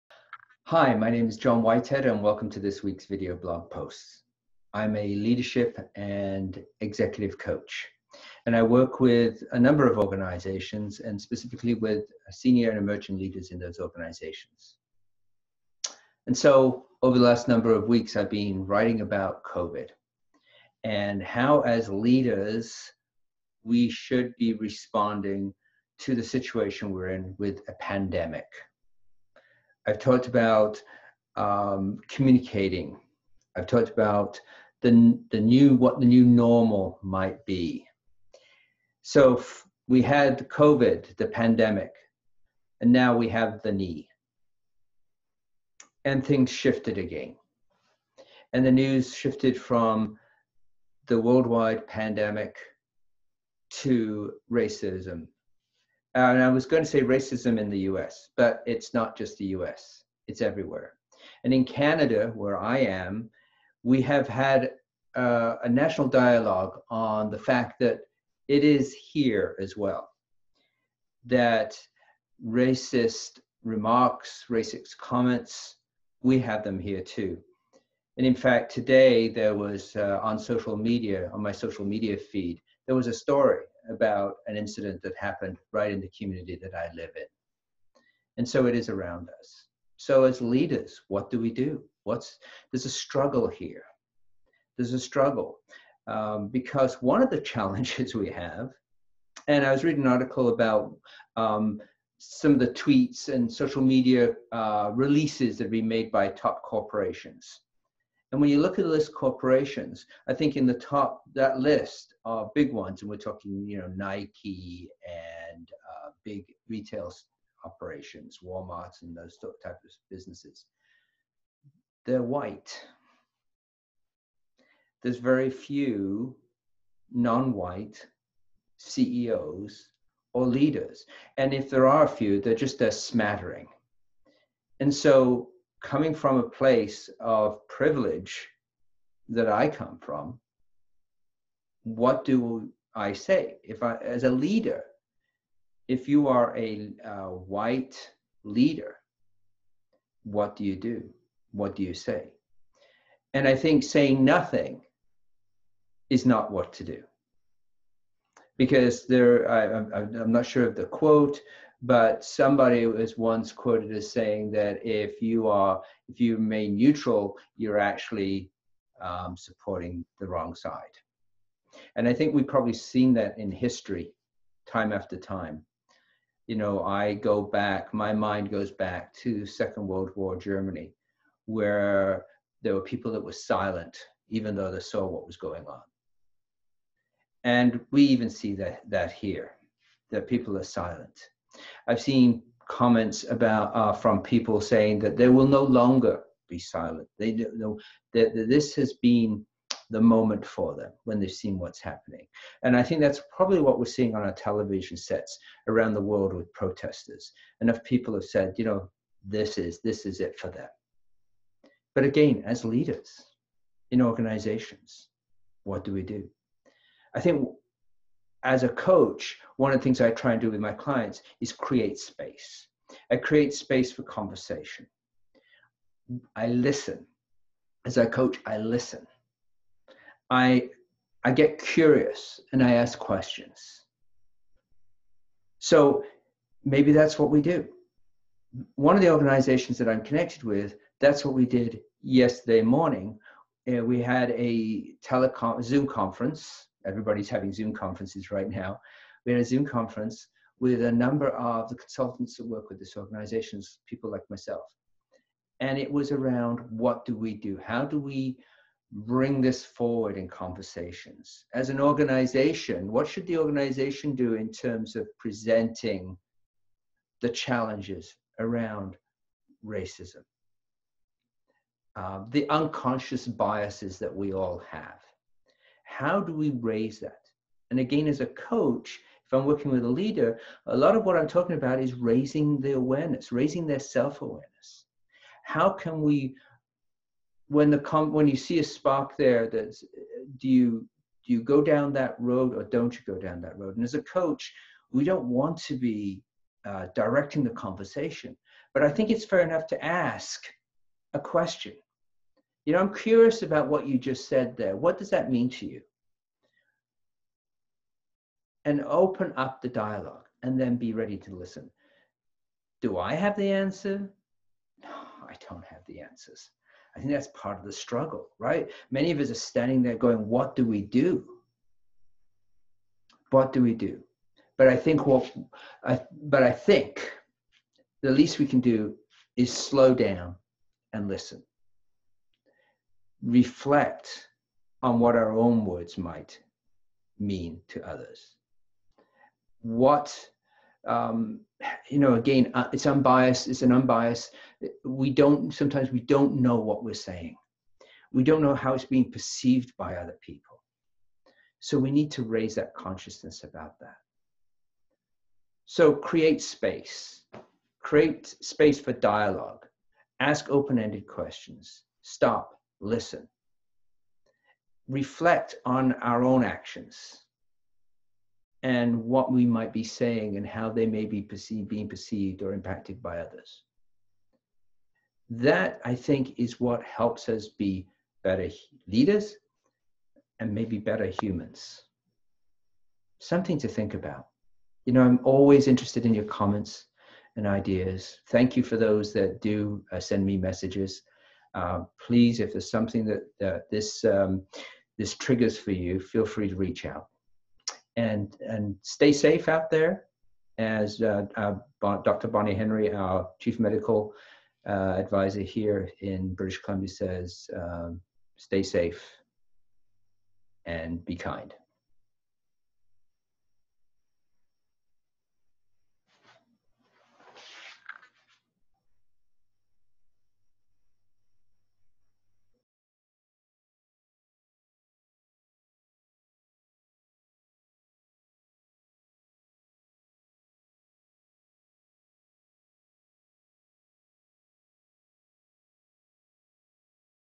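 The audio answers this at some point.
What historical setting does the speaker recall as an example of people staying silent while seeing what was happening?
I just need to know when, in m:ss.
2:59.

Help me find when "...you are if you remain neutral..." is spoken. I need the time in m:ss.
2:45.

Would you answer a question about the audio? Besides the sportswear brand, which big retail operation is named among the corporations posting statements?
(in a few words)
Walmart.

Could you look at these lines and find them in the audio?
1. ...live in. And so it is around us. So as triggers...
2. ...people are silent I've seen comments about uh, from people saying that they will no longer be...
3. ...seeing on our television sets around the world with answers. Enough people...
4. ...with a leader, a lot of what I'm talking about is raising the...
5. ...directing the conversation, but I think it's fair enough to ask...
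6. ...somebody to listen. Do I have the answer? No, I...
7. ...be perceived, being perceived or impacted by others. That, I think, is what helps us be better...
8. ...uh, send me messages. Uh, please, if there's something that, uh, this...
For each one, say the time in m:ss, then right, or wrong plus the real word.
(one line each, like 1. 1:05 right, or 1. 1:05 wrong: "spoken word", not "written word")
1. 1:26 wrong: "leaders", not "triggers"
2. 3:10 right
3. 3:23 wrong: "protesters", not "answers"
4. 4:39 right
5. 4:56 right
6. 5:10 wrong: "ready", not "somebody"
7. 6:11 right
8. 6:29 right.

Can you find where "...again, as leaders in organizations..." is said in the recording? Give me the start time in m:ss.
3:32.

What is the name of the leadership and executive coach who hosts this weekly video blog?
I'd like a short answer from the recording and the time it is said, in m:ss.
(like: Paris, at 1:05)
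John Whitehead, at 0:01.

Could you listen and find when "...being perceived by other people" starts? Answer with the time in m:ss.
5:48.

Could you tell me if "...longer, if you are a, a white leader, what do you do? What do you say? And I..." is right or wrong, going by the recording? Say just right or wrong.
wrong.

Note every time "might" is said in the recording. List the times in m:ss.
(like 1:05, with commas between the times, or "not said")
0:37, 5:35, 6:09.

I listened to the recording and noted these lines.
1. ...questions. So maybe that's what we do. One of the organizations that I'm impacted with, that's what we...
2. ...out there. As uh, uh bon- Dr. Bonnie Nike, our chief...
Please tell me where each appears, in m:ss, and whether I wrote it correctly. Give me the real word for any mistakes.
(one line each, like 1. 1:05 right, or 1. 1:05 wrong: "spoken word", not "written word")
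1. 3:52 wrong: "connected", not "impacted"
2. 6:39 wrong: "Henry", not "Nike".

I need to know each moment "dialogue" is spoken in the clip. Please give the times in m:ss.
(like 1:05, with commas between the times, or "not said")
1:06, 5:09, 5:58.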